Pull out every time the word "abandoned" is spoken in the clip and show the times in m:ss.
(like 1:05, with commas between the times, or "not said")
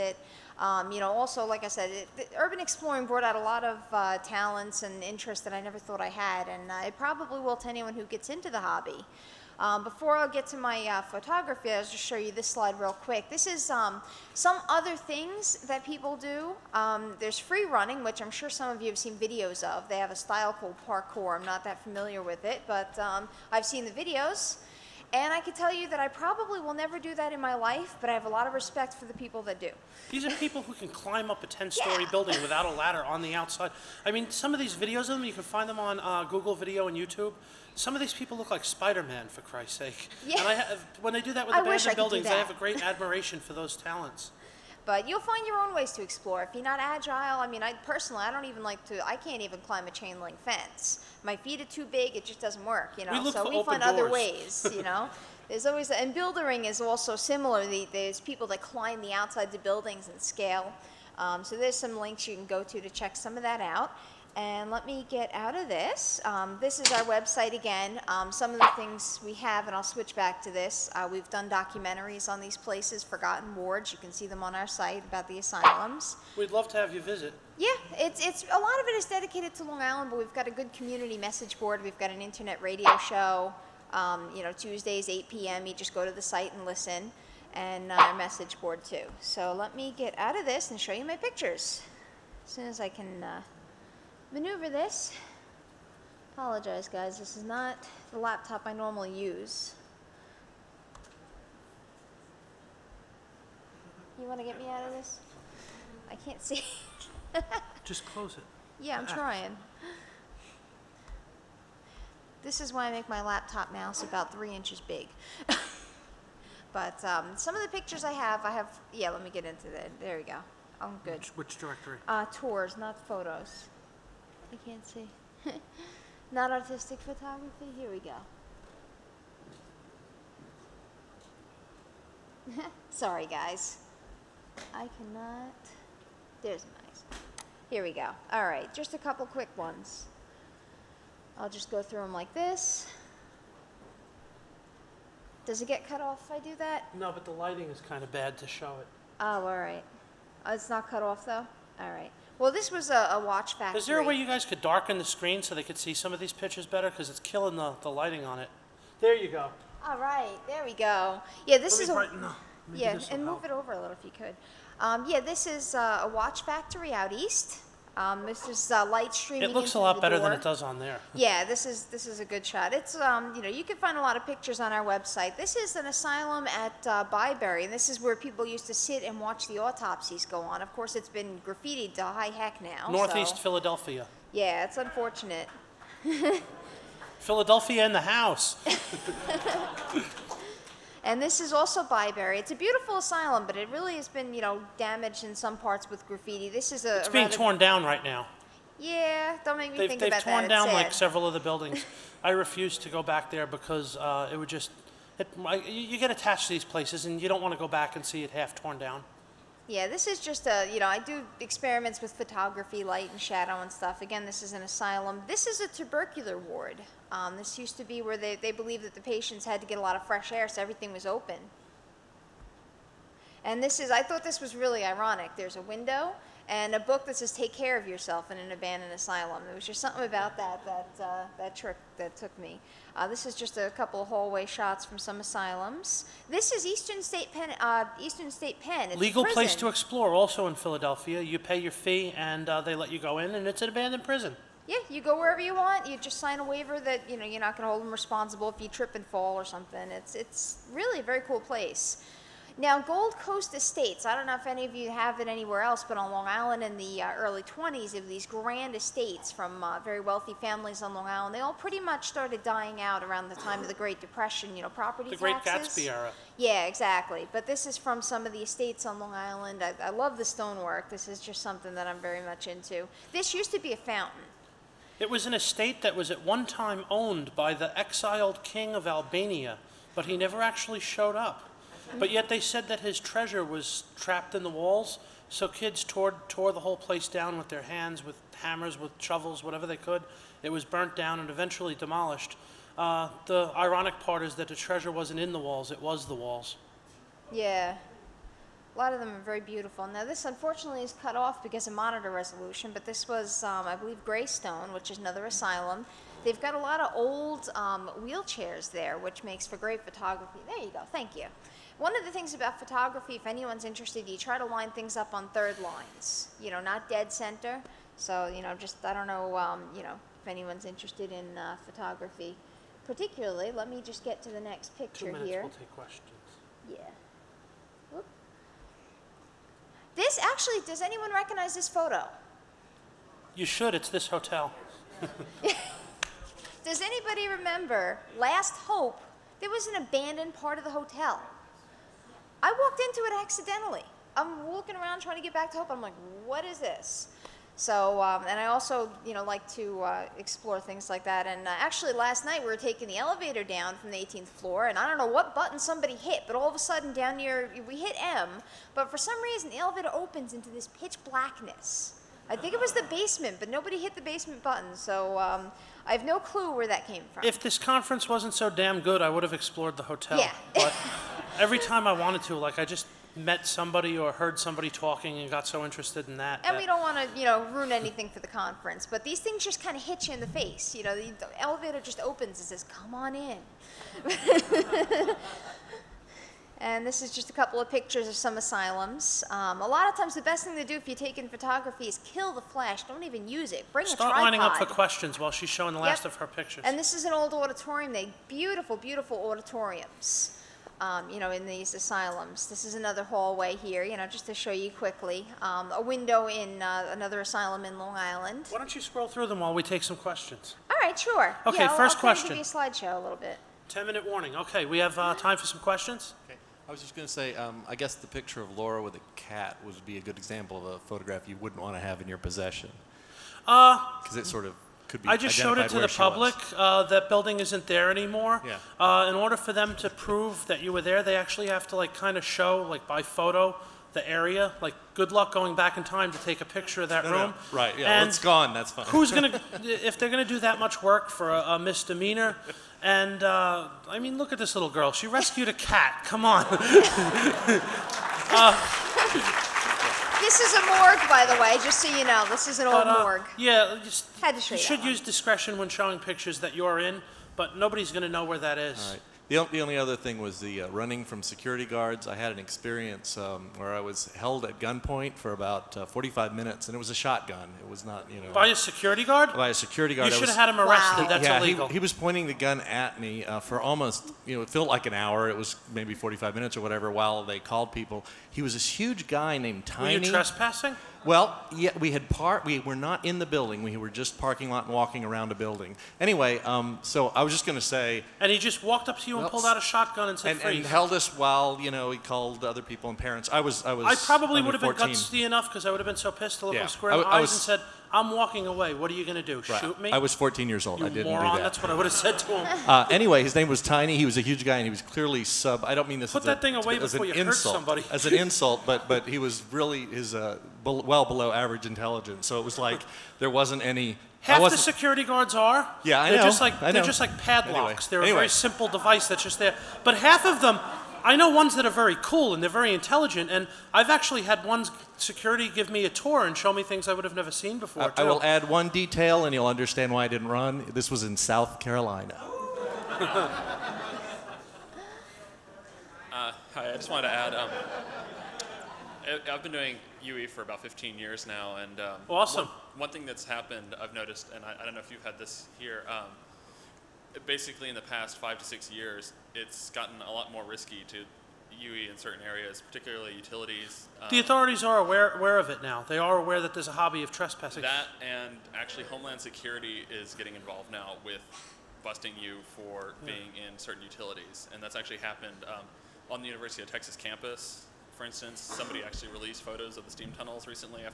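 0:41, 3:48, 4:03, 5:39.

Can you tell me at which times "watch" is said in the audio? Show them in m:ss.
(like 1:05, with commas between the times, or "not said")
2:33, 2:46, 2:59.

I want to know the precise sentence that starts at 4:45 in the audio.
So kids tore, tore the whole place down with their hands, with hammers, with shovels, whatever they could.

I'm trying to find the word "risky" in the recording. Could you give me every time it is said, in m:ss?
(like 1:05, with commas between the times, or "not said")
9:10.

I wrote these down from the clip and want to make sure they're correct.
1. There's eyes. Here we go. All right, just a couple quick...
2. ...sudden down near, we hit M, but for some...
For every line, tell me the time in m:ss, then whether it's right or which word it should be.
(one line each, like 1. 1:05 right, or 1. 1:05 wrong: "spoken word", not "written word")
1. 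2:16 right
2. 5:56 right.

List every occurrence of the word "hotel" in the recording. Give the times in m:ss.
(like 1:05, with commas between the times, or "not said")
5:34, 5:40, 6:09.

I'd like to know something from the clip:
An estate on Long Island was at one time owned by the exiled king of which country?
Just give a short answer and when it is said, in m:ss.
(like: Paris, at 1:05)
Albania, at 4:38.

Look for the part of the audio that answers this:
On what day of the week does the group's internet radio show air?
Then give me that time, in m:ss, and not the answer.
1:24.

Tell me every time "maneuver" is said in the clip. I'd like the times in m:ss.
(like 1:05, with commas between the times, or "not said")
1:34.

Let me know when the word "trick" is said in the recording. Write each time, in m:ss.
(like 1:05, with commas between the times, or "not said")
3:51.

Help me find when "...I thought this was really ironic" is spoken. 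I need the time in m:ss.
3:43.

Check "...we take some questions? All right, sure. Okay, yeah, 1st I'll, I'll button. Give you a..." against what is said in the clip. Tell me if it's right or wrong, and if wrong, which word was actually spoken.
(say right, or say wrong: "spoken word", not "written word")
wrong: "question", not "button".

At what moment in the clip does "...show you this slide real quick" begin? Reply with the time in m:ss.
0:11.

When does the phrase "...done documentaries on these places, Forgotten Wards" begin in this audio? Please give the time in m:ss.
1:11.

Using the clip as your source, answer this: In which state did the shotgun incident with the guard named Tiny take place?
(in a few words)
South Carolina.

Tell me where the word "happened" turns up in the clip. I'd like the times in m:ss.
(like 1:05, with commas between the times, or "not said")
9:03, 9:24.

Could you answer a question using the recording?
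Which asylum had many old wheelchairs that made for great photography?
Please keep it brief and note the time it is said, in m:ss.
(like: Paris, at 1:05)
Greystone, at 5:04.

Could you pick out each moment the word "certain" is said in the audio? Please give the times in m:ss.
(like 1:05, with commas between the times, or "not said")
9:11, 9:23.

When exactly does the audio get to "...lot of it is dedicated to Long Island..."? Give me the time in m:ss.
1:18.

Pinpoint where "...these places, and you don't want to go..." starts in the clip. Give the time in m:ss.
3:26.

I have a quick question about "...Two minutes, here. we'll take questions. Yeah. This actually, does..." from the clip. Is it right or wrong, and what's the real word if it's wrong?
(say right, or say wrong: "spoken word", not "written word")
right.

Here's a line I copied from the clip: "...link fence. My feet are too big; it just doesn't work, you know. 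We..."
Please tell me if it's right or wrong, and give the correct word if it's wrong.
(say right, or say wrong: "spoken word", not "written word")
right.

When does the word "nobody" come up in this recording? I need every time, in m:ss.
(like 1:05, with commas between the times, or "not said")
6:03, 7:37.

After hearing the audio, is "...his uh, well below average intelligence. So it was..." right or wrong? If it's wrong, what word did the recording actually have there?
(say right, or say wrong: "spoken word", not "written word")
right.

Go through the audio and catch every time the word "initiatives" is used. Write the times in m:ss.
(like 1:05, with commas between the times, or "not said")
not said.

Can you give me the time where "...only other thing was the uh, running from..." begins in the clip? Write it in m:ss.
7:39.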